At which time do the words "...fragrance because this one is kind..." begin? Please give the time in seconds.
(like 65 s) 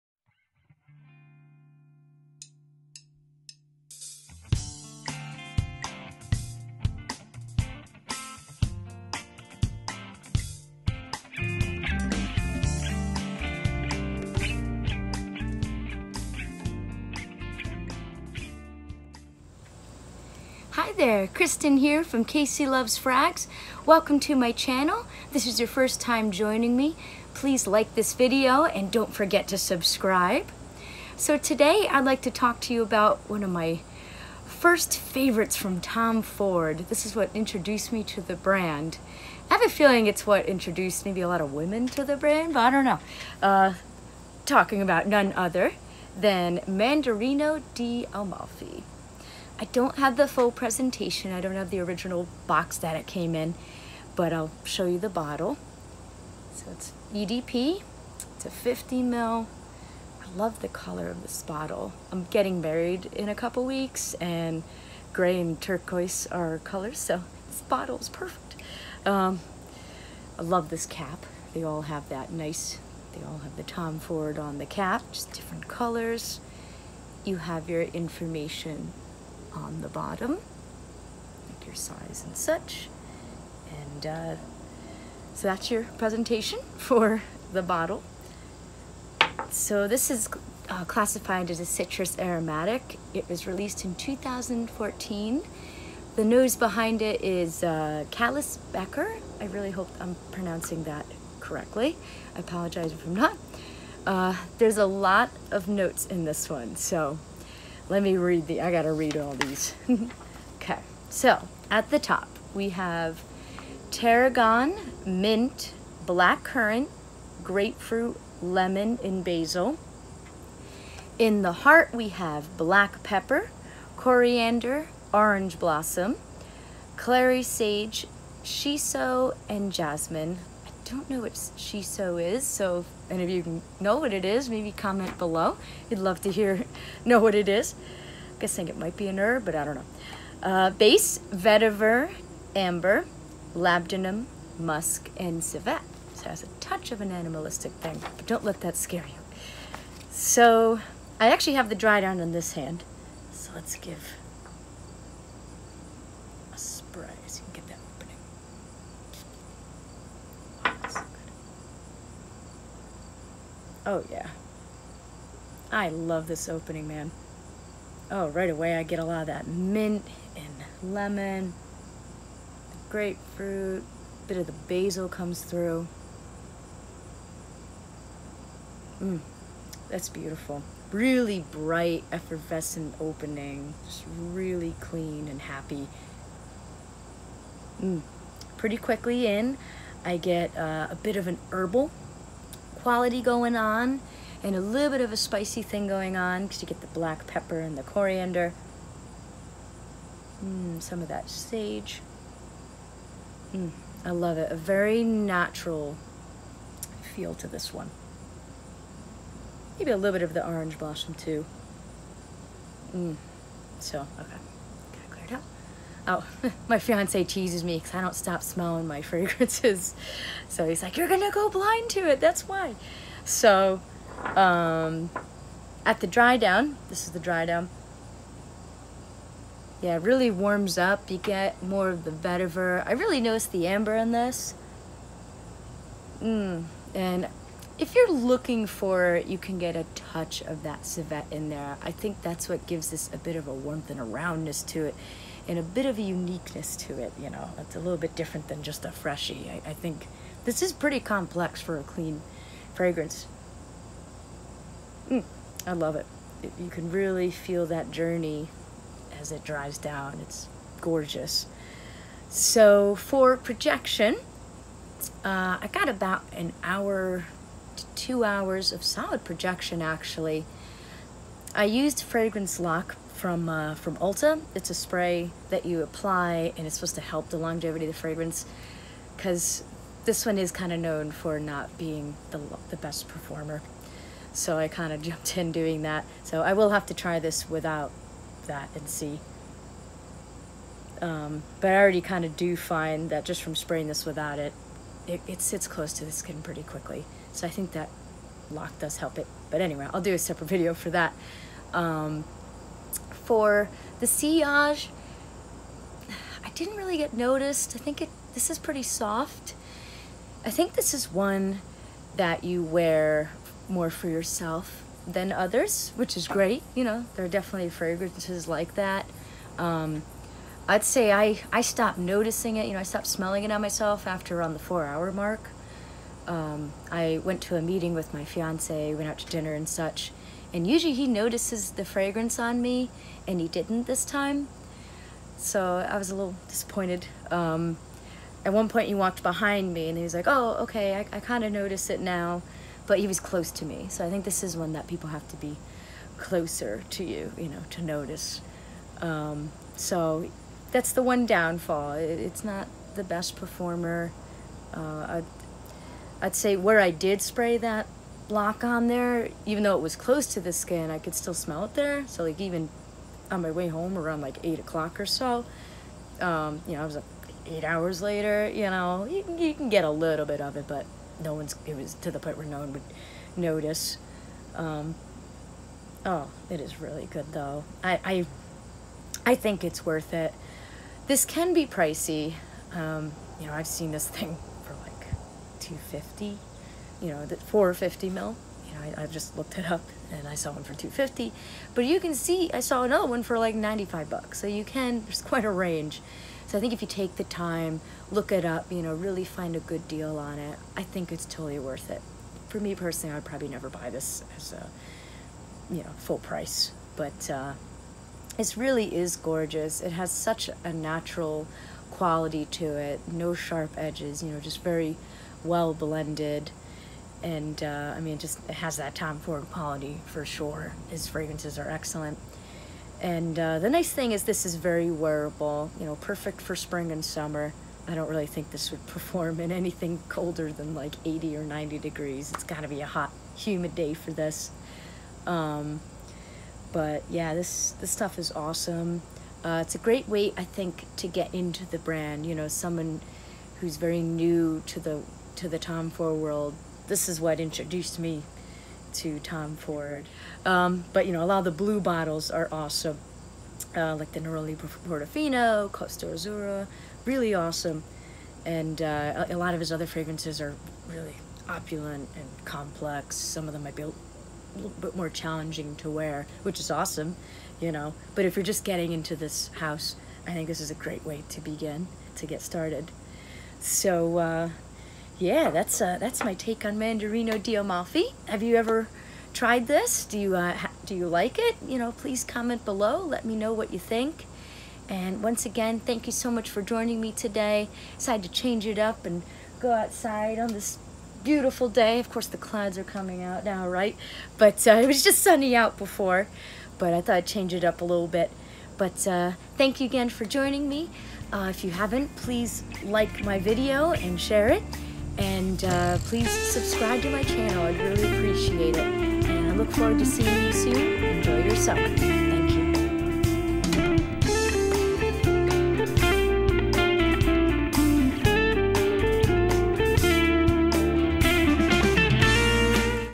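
277 s.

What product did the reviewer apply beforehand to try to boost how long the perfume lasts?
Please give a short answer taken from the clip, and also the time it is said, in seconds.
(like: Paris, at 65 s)
Fragrance Lock, at 272 s.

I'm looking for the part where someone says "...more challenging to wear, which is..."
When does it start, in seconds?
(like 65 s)
464 s.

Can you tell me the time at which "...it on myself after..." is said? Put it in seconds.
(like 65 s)
323 s.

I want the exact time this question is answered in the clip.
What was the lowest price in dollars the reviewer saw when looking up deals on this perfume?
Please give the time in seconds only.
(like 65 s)
393 s.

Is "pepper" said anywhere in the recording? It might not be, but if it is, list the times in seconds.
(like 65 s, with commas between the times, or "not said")
123 s, 197 s.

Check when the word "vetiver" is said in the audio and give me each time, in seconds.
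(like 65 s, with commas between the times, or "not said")
141 s, 232 s.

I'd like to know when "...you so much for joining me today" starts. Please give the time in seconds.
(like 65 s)
486 s.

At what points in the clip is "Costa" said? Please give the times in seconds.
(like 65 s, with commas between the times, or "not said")
455 s.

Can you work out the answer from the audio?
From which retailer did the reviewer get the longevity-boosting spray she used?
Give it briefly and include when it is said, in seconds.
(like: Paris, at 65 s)
Ulta, at 273 s.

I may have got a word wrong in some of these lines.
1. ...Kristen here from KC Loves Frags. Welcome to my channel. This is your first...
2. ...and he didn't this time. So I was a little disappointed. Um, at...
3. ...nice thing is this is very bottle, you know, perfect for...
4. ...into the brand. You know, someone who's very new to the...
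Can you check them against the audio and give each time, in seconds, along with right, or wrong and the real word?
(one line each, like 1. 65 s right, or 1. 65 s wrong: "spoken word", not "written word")
1. 21 s right
2. 333 s right
3. 423 s wrong: "wearable", not "bottle"
4. 441 s right.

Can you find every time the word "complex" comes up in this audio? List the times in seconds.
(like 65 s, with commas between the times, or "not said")
250 s, 462 s.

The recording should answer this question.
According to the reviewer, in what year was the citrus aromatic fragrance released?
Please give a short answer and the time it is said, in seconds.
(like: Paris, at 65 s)
2014, at 93 s.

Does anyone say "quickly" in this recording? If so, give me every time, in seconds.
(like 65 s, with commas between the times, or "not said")
188 s, 296 s.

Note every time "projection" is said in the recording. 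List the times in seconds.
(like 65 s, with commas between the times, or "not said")
263 s, 269 s.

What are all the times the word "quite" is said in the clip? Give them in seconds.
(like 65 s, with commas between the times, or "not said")
395 s.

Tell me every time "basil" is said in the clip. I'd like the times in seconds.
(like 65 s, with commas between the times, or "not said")
119 s, 174 s.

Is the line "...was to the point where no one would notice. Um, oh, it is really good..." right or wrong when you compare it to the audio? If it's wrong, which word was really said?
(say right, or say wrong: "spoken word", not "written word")
right.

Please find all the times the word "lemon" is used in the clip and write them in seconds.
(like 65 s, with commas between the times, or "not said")
118 s, 170 s.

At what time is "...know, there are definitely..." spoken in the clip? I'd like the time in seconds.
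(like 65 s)
316 s.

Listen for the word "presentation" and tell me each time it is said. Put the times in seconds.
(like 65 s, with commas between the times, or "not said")
50 s, 85 s.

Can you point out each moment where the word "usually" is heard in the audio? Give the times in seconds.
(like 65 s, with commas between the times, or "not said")
330 s.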